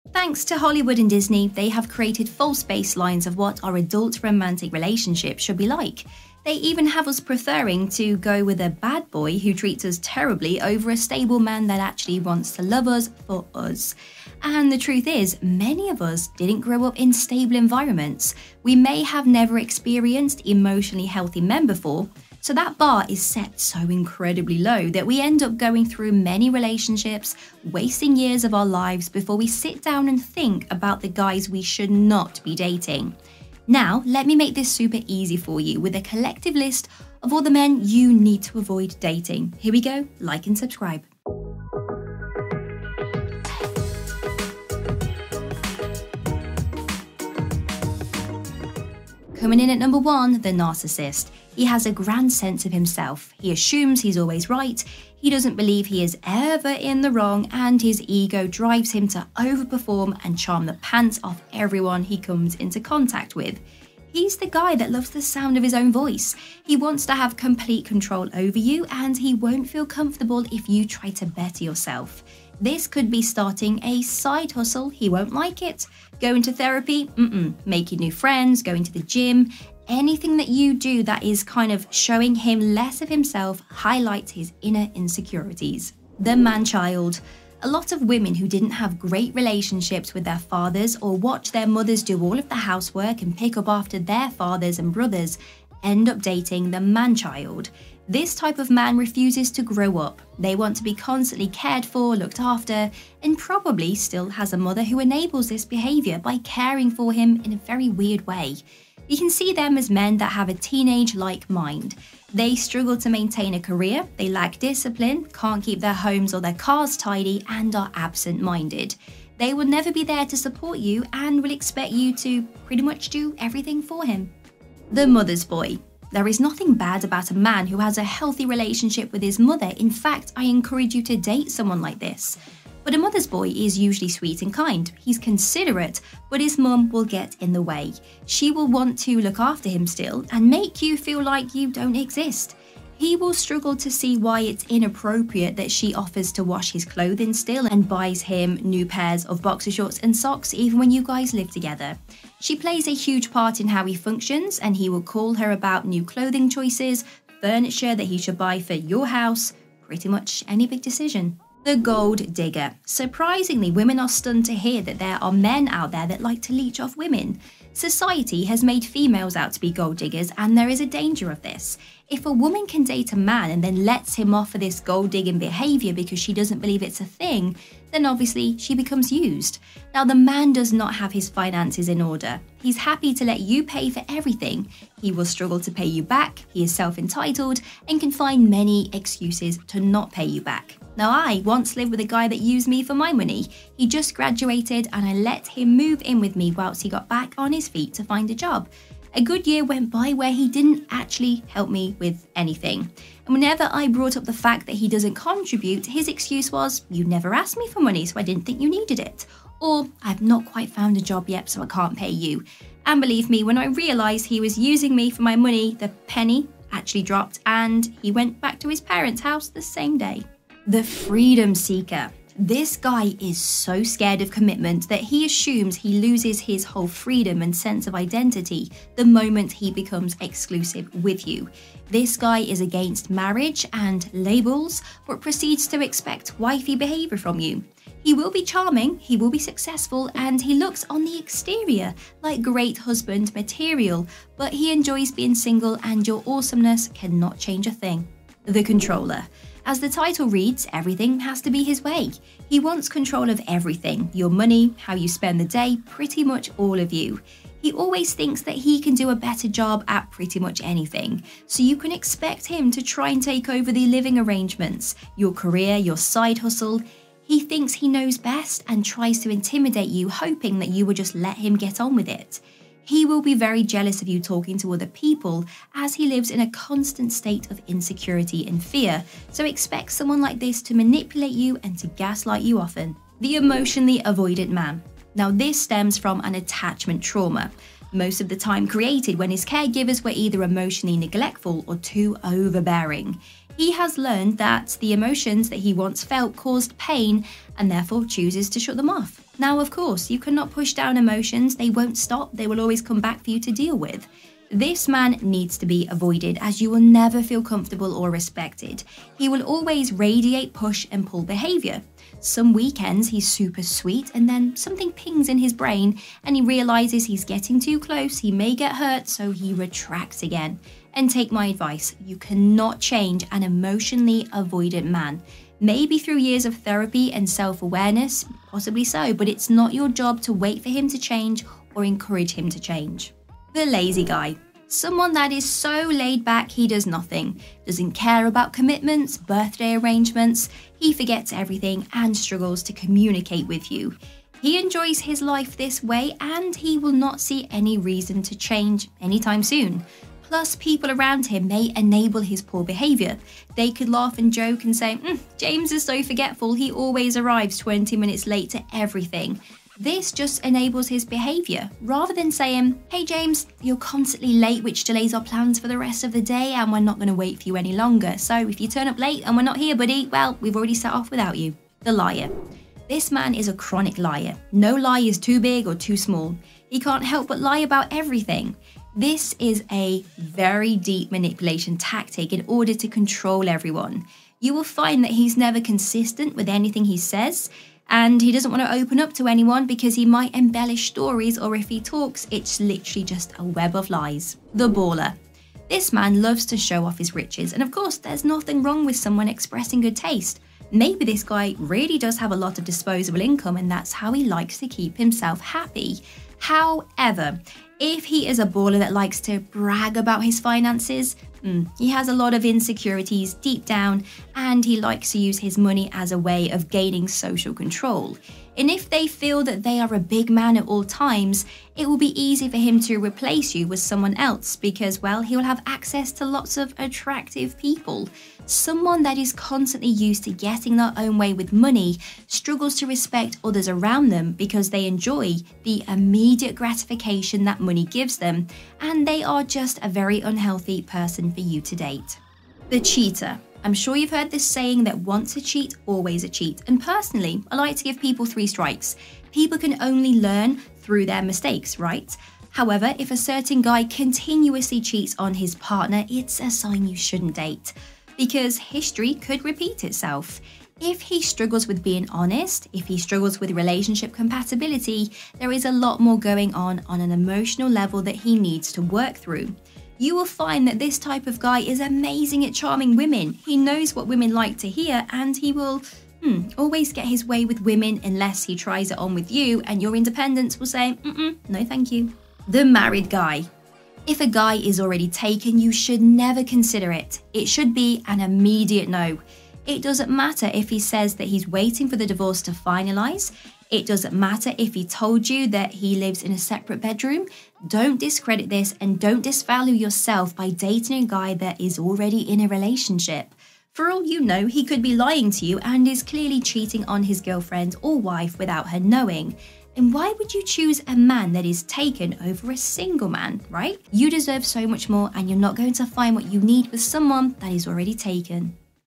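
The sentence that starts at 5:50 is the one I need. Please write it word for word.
Plus, people around him may enable his poor behaviour.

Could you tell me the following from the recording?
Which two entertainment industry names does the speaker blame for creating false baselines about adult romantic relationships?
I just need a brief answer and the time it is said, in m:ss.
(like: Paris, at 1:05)
Hollywood and Disney, at 0:00.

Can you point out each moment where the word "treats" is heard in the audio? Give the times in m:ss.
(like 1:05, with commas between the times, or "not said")
0:09.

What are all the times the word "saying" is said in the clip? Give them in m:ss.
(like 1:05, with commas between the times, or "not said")
6:02, 7:24.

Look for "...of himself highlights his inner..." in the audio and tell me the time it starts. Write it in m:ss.
1:23.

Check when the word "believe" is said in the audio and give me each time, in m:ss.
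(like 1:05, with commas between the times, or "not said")
0:55, 2:56, 3:33.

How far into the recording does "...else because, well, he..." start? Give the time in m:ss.
7:04.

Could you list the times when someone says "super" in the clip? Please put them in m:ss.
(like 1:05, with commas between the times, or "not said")
0:34, 5:13.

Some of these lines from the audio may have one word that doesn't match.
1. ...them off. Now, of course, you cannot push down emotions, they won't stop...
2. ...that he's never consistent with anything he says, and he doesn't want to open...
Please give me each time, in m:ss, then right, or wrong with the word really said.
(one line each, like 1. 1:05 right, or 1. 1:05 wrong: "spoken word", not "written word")
1. 4:58 right
2. 6:25 right.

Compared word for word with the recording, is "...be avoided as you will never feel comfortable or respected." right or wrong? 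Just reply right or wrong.
right.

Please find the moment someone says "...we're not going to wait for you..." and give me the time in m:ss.
6:06.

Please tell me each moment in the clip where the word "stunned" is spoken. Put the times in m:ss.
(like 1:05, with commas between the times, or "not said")
2:44.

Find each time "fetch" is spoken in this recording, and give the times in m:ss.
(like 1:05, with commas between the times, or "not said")
not said.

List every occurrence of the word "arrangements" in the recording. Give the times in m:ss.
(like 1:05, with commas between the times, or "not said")
4:24, 5:39.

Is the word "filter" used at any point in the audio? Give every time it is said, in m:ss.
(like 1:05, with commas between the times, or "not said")
not said.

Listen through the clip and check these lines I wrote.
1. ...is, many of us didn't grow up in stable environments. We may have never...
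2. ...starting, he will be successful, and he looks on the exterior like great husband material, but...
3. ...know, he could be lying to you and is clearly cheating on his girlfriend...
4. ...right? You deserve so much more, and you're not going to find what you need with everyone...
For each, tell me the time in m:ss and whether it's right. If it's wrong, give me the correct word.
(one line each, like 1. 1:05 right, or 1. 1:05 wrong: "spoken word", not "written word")
1. 0:15 right
2. 3:58 wrong: "charming", not "starting"
3. 8:24 right
4. 8:33 wrong: "someone", not "everyone".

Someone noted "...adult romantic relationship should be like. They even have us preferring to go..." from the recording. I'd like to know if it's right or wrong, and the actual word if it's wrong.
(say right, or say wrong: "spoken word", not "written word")
right.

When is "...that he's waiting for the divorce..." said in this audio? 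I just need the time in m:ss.
8:11.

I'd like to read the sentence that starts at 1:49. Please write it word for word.
You can see them as men that have a teenage like mind.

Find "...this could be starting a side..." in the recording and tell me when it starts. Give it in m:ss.
1:12.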